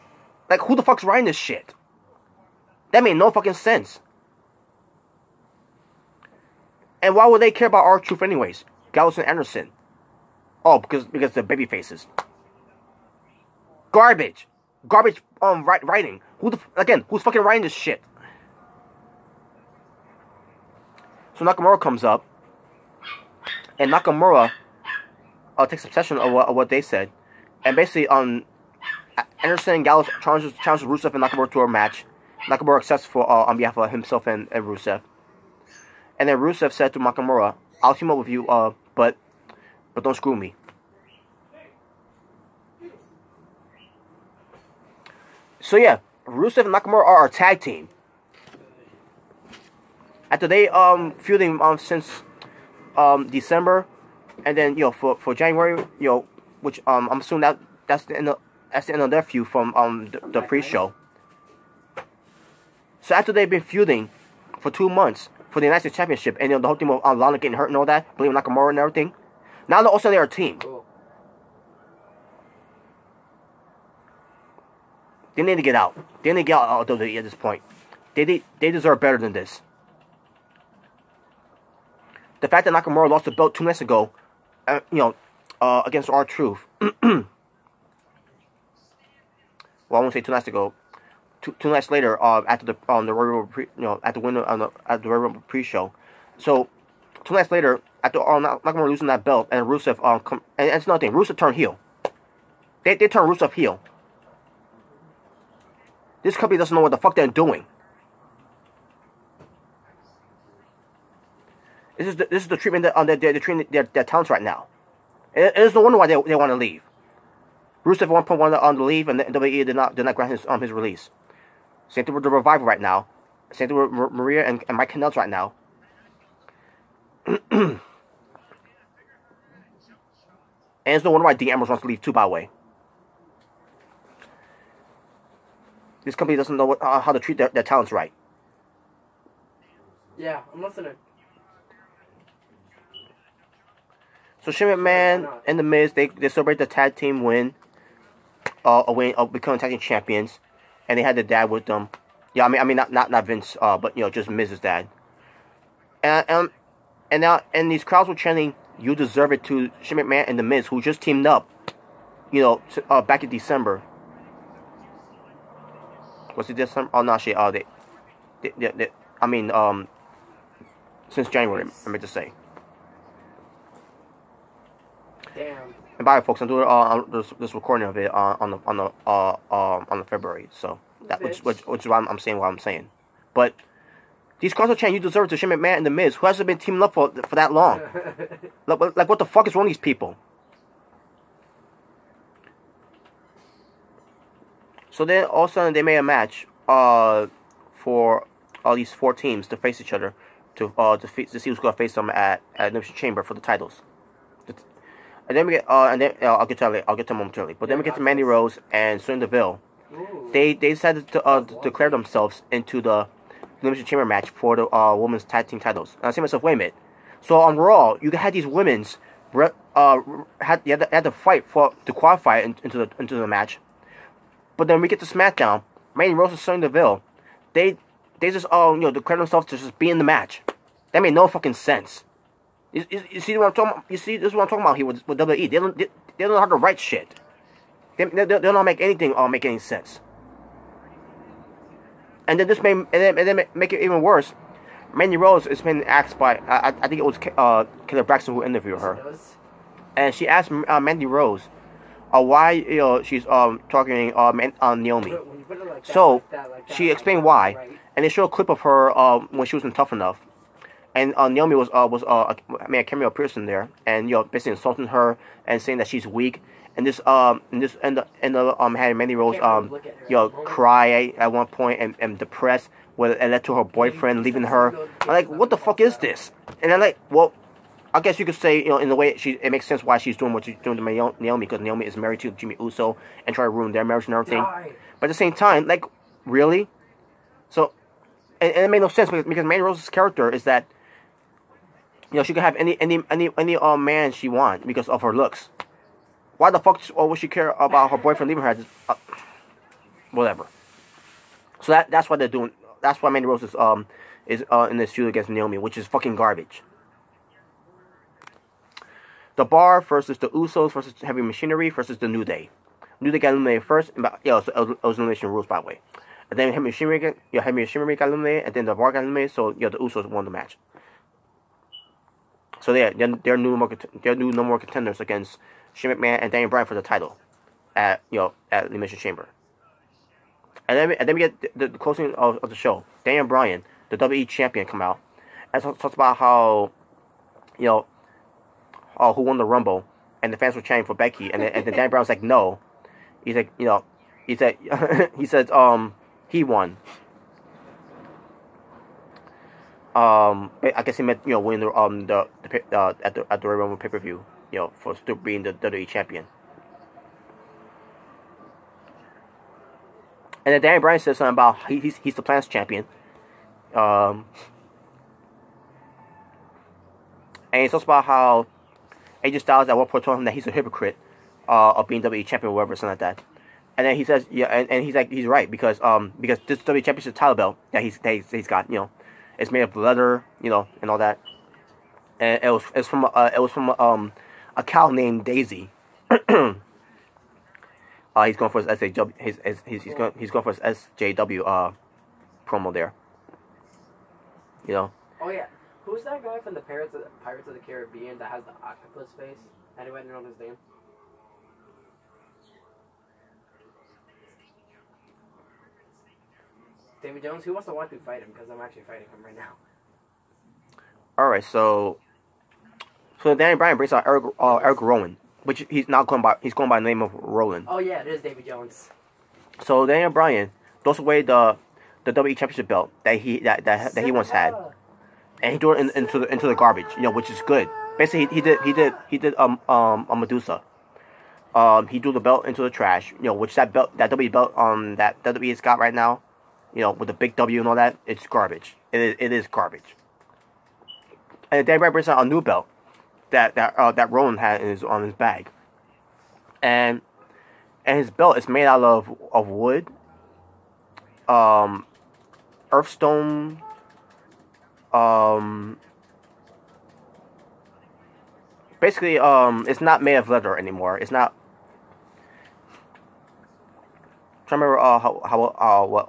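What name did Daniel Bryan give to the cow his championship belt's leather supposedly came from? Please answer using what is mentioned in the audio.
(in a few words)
Daisy.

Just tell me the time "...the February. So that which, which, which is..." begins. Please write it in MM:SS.
02:59.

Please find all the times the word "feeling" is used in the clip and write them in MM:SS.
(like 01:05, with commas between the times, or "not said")
not said.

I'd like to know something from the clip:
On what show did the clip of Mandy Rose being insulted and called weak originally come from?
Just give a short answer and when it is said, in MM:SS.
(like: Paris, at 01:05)
Tough Enough, at 04:19.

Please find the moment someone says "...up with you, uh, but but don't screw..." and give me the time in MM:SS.
00:38.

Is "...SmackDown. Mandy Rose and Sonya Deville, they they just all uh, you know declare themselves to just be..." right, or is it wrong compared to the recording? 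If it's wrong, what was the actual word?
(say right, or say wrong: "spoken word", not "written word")
right.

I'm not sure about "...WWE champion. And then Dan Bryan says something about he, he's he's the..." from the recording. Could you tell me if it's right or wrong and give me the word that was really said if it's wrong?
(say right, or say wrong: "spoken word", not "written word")
right.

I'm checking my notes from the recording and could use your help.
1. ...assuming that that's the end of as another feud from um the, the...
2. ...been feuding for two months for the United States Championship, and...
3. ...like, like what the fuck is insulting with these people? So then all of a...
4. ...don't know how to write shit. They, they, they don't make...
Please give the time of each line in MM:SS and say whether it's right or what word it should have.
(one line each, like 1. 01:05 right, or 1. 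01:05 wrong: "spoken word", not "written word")
1. 00:57 right
2. 01:03 right
3. 03:08 wrong: "wrong", not "insulting"
4. 03:56 right.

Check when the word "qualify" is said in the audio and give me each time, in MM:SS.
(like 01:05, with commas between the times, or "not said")
03:41.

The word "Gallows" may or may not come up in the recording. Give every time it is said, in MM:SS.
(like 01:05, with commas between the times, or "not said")
00:08, 00:29.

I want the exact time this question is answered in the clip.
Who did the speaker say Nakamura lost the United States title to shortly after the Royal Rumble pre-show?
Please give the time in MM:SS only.
01:26.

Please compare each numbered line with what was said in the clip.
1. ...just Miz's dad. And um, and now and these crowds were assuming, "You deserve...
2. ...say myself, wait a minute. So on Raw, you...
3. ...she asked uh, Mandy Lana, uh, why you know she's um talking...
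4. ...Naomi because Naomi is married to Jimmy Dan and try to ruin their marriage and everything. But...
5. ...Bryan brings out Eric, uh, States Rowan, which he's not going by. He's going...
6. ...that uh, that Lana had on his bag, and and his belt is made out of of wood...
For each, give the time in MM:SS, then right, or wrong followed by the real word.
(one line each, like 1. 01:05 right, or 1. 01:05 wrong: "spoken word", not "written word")
1. 02:34 wrong: "chanting", not "assuming"
2. 03:36 right
3. 04:10 wrong: "Rose", not "Lana"
4. 04:40 wrong: "Uso", not "Dan"
5. 06:53 wrong: "Eric", not "States"
6. 07:23 wrong: "Rowan", not "Lana".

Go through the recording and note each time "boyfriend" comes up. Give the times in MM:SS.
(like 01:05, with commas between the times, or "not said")
04:33, 04:57.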